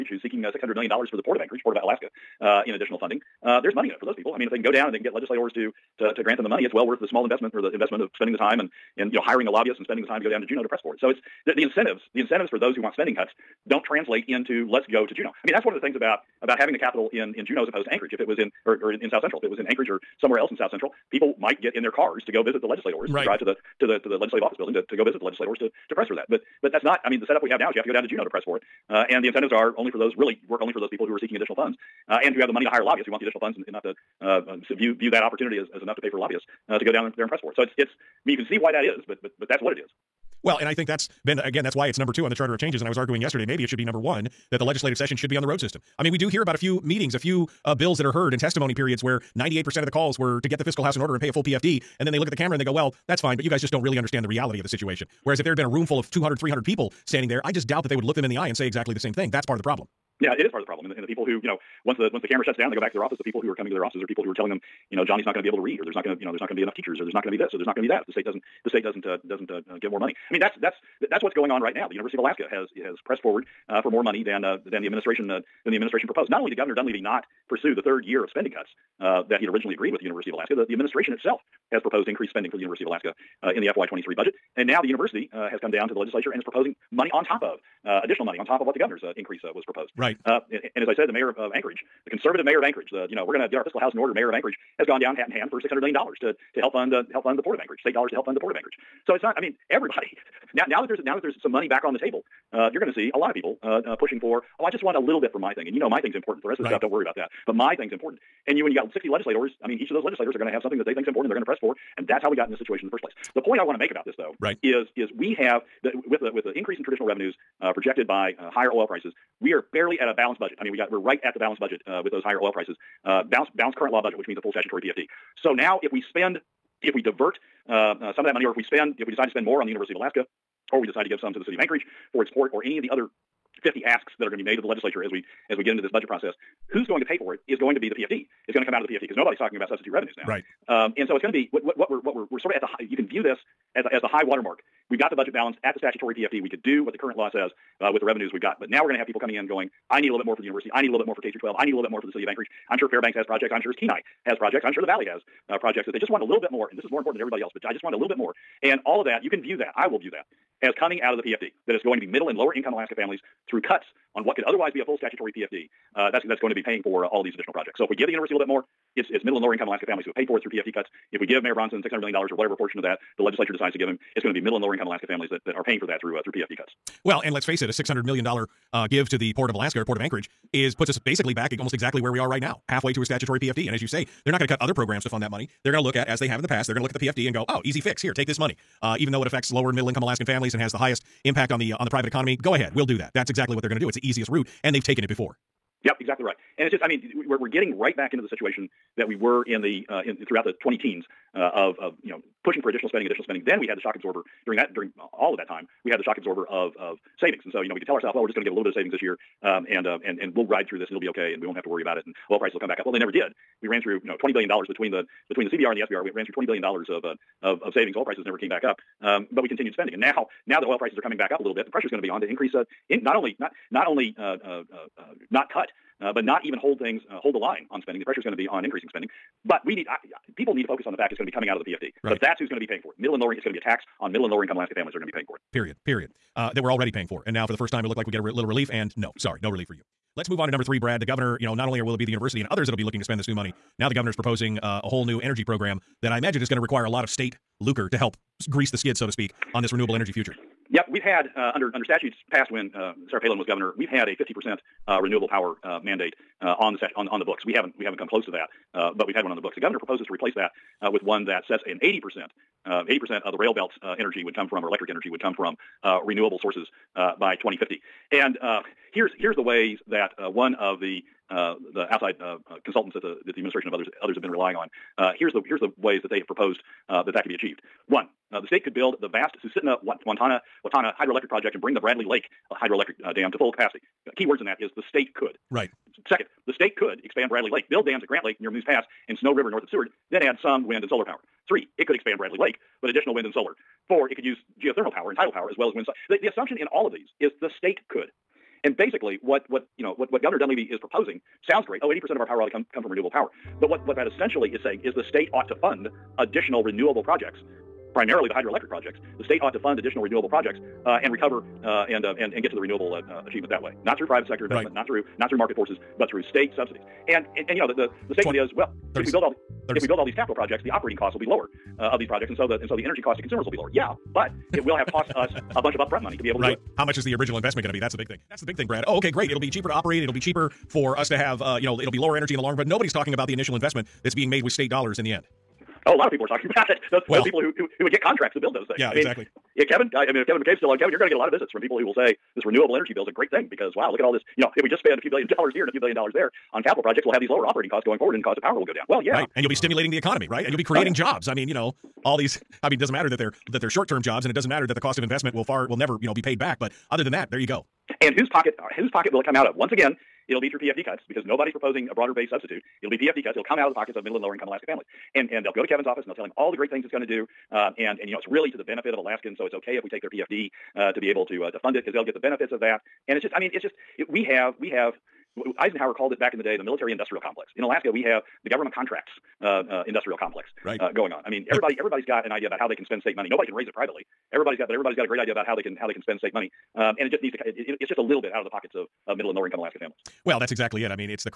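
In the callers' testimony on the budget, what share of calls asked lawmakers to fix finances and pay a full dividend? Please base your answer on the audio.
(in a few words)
98%.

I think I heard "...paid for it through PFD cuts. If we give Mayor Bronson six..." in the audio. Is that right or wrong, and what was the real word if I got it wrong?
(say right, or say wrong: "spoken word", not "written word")
right.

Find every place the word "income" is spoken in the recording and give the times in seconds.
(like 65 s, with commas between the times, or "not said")
162 s, 169 s, 174 s, 189 s, 234 s, 364 s, 389 s.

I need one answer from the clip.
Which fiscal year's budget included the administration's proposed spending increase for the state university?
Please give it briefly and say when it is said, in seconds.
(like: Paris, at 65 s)
FY23, at 83 s.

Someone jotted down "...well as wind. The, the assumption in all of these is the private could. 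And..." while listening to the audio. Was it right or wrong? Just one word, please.
wrong.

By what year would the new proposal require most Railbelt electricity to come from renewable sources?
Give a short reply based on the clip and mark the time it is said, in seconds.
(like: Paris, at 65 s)
2050, at 267 s.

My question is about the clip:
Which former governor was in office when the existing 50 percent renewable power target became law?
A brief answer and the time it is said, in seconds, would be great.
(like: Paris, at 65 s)
Sarah Palin, at 253 s.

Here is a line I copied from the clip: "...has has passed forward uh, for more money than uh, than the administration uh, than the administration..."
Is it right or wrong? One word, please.
wrong.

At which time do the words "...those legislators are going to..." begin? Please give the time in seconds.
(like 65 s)
109 s.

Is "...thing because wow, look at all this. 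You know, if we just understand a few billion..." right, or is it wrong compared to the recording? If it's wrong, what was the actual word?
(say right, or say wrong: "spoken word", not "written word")
wrong: "spend", not "understand".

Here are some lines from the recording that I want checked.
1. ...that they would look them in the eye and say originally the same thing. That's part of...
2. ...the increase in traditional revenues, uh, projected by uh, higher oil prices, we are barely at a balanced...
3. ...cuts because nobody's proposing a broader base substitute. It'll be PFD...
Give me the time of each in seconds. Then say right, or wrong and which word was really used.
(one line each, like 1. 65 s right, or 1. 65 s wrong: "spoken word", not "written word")
1. 57 s wrong: "exactly", not "originally"
2. 116 s right
3. 360 s right.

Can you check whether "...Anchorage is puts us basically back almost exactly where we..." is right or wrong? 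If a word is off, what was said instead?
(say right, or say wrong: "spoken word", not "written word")
right.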